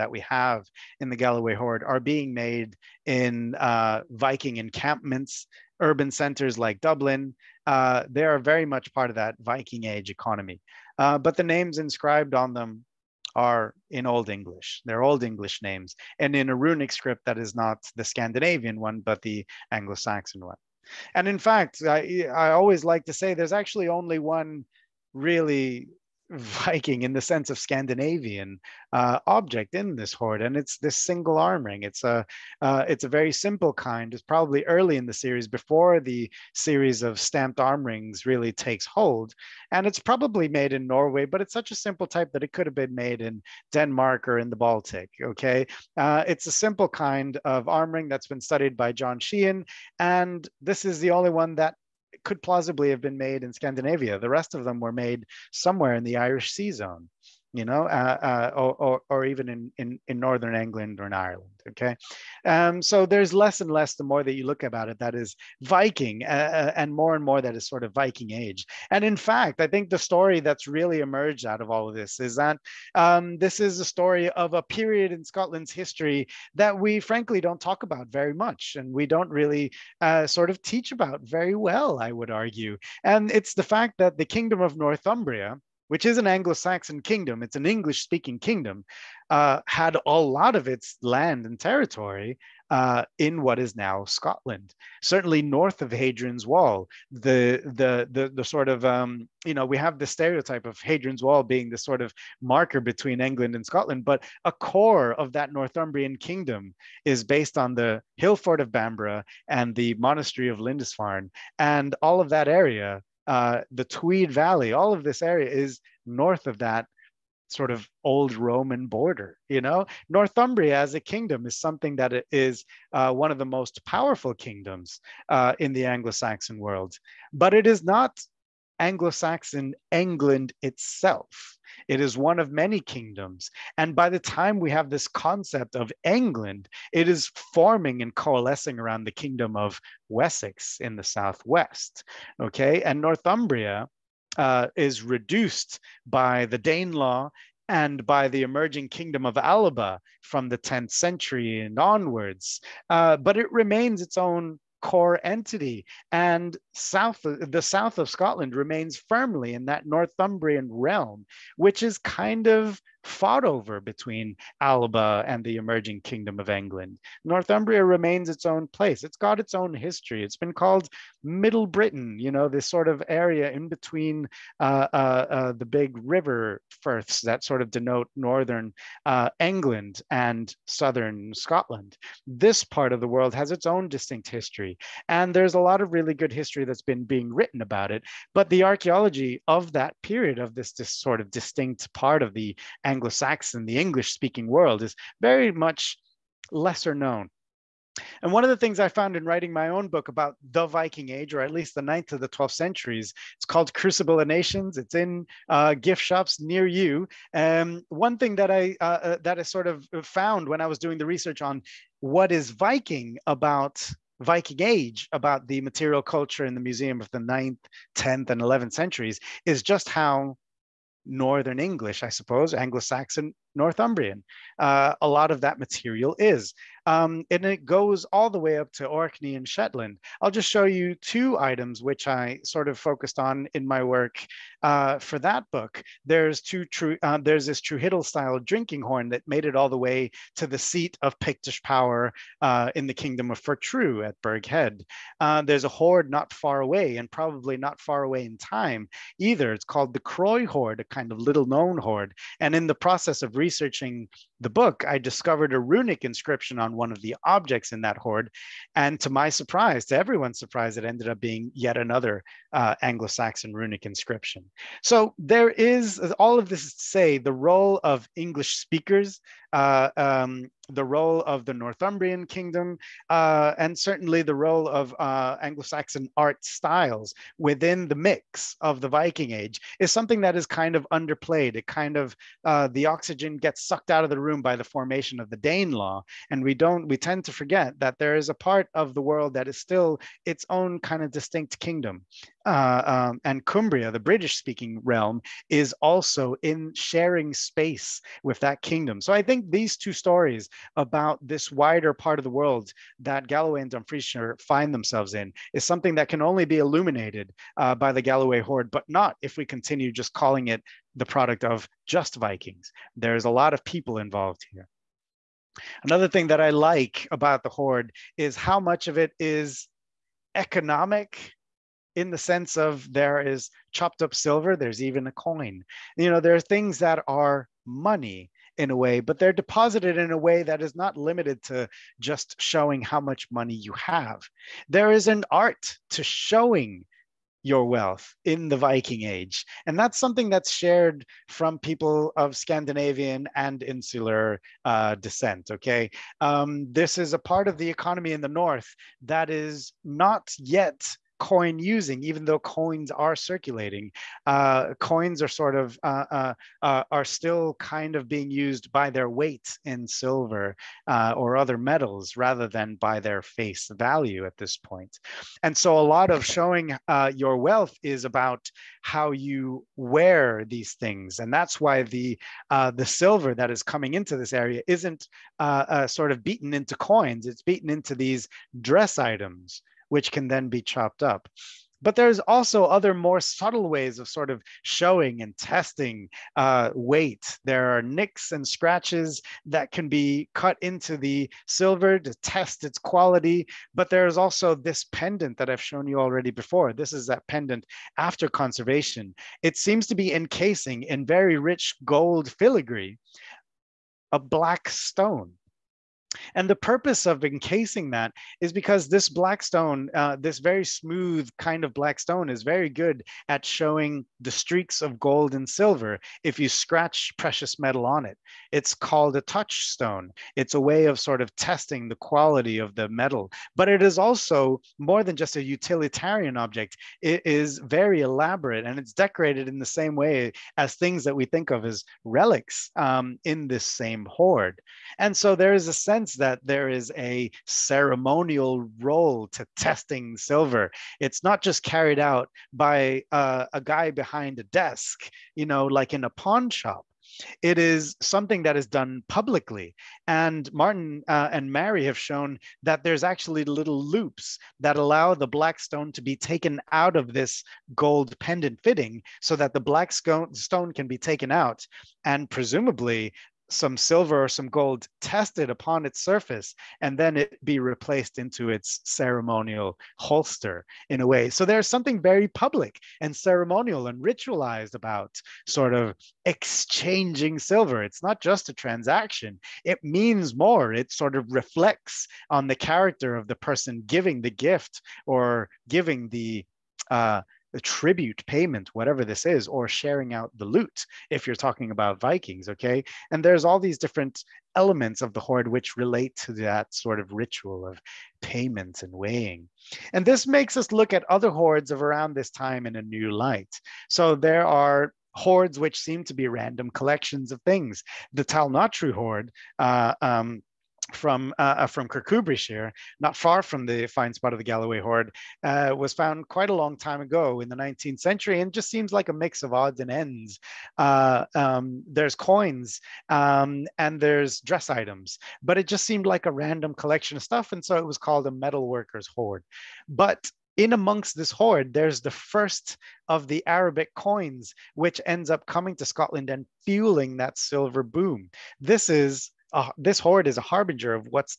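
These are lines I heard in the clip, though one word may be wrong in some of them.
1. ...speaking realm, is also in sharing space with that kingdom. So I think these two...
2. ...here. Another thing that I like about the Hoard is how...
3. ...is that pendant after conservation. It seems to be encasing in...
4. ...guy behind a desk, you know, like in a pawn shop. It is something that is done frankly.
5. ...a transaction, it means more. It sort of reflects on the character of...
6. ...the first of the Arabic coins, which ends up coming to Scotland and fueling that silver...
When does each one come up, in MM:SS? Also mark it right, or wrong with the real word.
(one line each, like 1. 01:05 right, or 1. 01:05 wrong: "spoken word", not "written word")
1. 04:54 right
2. 05:14 right
3. 06:36 right
4. 07:23 wrong: "publicly", not "frankly"
5. 07:58 right
6. 08:52 right.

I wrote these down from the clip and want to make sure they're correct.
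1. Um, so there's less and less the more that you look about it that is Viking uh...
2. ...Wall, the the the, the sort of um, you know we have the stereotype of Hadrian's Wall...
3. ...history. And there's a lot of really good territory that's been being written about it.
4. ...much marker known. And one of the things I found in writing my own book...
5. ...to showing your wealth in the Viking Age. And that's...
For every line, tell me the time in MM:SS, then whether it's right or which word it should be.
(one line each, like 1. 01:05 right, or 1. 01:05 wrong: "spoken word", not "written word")
1. 01:02 right
2. 01:36 right
3. 03:04 wrong: "history", not "territory"
4. 03:15 wrong: "lesser", not "marker"
5. 05:35 right.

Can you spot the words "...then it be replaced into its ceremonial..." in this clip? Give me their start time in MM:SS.
07:46.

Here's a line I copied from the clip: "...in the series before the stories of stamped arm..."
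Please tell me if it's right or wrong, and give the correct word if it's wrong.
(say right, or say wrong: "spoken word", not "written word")
wrong: "series", not "stories".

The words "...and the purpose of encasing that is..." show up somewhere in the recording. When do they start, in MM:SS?
06:46.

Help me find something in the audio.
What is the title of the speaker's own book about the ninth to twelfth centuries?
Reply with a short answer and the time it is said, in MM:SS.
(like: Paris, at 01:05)
Crucible of Nations, at 03:23.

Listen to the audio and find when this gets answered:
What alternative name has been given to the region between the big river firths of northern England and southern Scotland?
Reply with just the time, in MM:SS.
02:51.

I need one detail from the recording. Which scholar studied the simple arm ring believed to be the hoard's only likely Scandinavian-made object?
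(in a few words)
John Sheehan.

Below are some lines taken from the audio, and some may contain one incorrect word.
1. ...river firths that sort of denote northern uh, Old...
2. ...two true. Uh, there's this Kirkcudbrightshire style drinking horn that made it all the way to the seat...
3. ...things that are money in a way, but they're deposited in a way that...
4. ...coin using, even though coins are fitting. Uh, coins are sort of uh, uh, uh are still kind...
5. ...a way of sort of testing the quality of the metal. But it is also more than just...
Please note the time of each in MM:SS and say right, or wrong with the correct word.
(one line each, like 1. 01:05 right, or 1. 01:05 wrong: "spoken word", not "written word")
1. 02:56 wrong: "England", not "Old"
2. 03:56 wrong: "Trewhiddle", not "Kirkcudbrightshire"
3. 05:26 right
4. 05:51 wrong: "circulating", not "fitting"
5. 07:00 right.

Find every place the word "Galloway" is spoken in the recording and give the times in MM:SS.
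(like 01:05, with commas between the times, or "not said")
00:01, 05:03, 05:08, 08:34.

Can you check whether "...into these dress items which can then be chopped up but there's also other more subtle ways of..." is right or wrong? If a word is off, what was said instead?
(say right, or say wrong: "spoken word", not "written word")
right.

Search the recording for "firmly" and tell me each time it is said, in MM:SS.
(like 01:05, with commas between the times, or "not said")
02:39.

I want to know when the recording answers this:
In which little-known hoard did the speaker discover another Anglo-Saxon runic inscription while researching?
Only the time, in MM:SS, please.
04:09.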